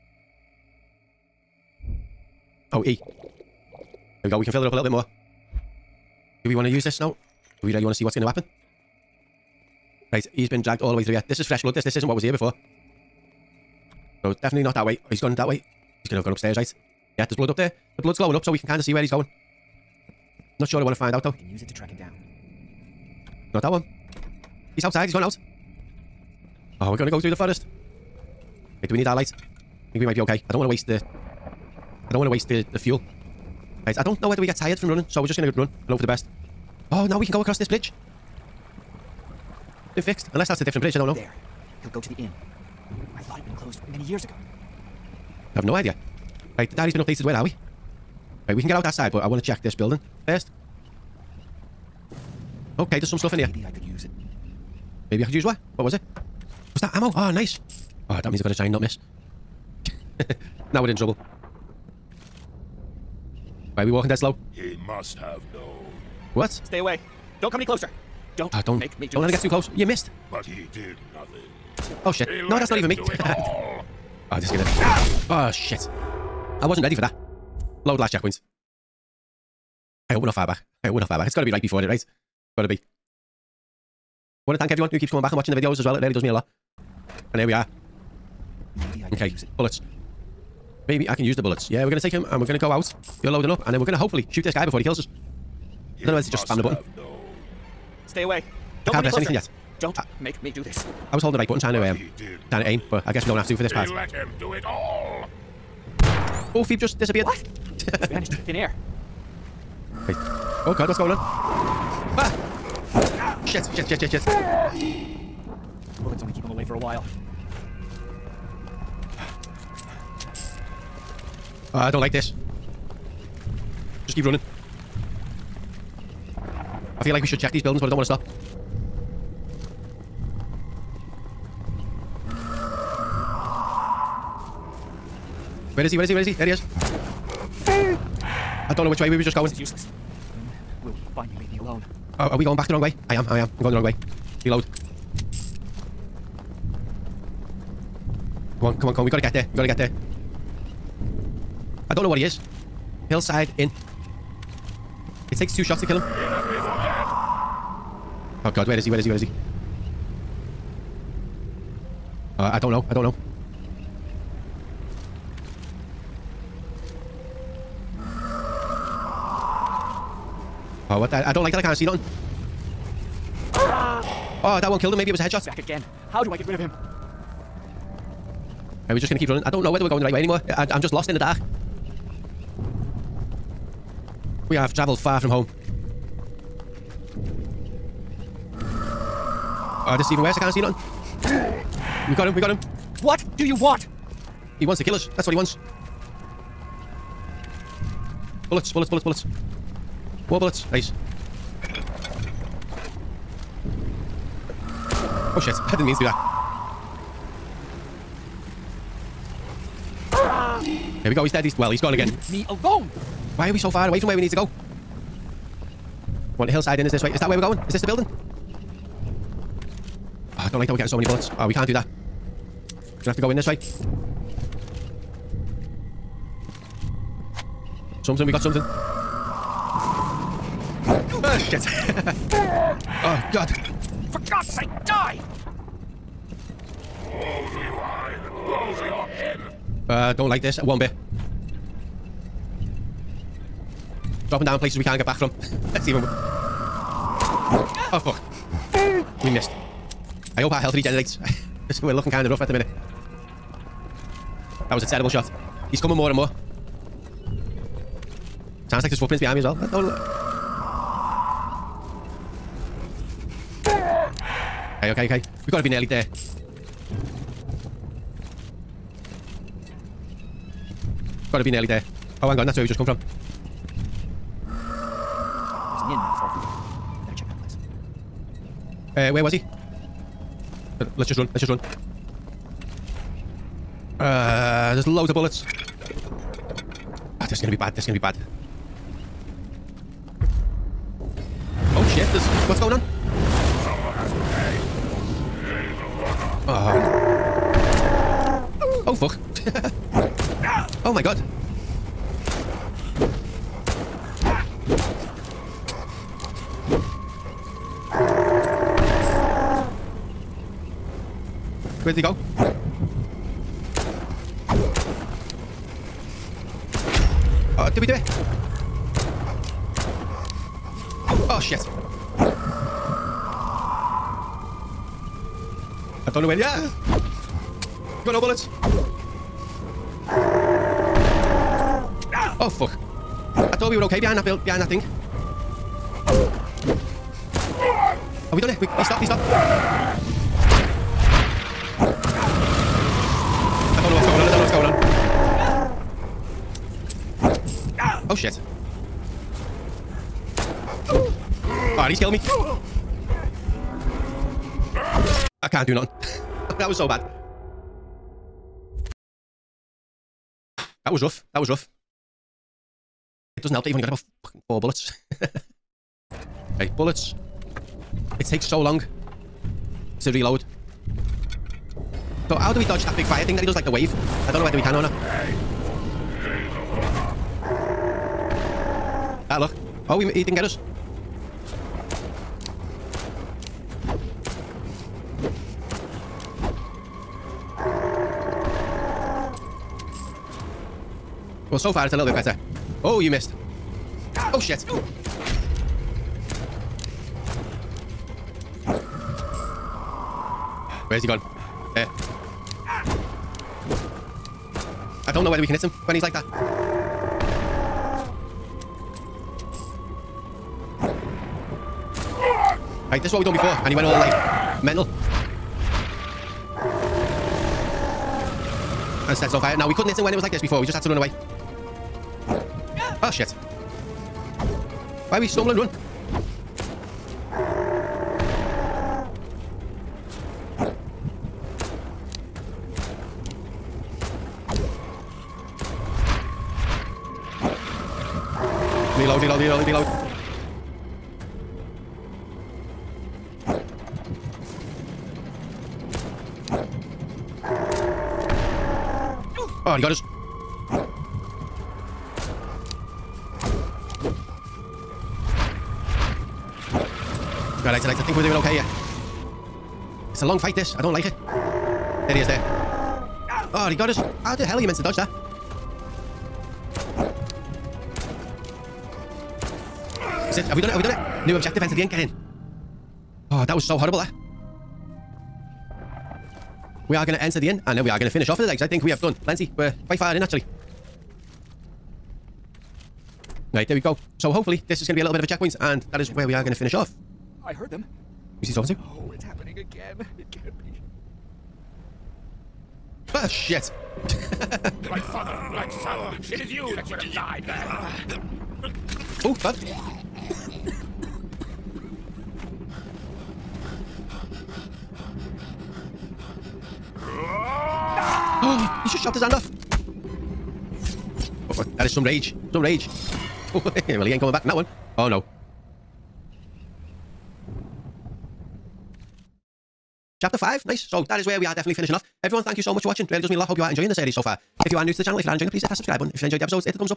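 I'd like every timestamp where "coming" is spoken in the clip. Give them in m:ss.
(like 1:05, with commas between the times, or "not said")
1:25, 4:15, 8:34.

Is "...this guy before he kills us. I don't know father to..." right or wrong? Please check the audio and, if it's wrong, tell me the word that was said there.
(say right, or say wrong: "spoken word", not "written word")
wrong: "whether", not "father".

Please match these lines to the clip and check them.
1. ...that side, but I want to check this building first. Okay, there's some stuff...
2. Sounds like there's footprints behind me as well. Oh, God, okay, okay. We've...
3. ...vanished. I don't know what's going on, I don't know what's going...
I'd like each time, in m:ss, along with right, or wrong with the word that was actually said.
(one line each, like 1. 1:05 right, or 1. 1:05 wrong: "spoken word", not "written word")
1. 0:48 right
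2. 4:18 wrong: "Okay", not "God"
3. 5:39 wrong: "stopped", not "vanished".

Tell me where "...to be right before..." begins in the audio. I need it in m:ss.
1:21.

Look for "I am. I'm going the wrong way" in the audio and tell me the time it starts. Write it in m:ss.
2:23.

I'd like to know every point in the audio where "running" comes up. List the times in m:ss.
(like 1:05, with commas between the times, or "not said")
0:34, 2:04, 2:59.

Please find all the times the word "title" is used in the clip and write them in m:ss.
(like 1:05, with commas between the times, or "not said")
not said.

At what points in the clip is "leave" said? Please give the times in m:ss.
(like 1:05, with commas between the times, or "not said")
2:21, 3:32.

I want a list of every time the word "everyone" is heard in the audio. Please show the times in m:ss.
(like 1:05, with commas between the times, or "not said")
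1:24, 8:42.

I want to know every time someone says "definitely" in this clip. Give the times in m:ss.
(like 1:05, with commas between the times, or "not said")
0:14, 8:41.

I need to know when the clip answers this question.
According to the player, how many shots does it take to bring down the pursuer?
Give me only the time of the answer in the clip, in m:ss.
2:35.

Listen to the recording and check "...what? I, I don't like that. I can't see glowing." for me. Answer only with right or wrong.
wrong.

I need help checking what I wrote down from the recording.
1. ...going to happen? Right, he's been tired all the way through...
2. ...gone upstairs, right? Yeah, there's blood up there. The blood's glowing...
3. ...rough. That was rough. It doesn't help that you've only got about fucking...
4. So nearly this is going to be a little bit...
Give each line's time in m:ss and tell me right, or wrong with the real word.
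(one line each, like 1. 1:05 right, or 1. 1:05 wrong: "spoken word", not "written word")
1. 0:08 wrong: "dragged", not "tired"
2. 0:16 right
3. 6:01 right
4. 8:04 wrong: "hopefully", not "nearly".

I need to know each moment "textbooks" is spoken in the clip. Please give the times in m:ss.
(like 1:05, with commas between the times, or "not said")
not said.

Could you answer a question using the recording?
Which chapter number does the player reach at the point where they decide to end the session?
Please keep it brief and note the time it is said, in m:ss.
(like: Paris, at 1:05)
5, at 8:40.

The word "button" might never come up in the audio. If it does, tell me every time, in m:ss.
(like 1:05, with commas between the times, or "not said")
1:36, 1:41, 8:45.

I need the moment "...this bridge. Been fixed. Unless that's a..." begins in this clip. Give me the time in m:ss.
0:37.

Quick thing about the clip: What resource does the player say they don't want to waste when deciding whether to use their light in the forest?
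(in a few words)
Fuel.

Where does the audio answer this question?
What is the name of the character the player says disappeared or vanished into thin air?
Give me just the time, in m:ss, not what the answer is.
1:46.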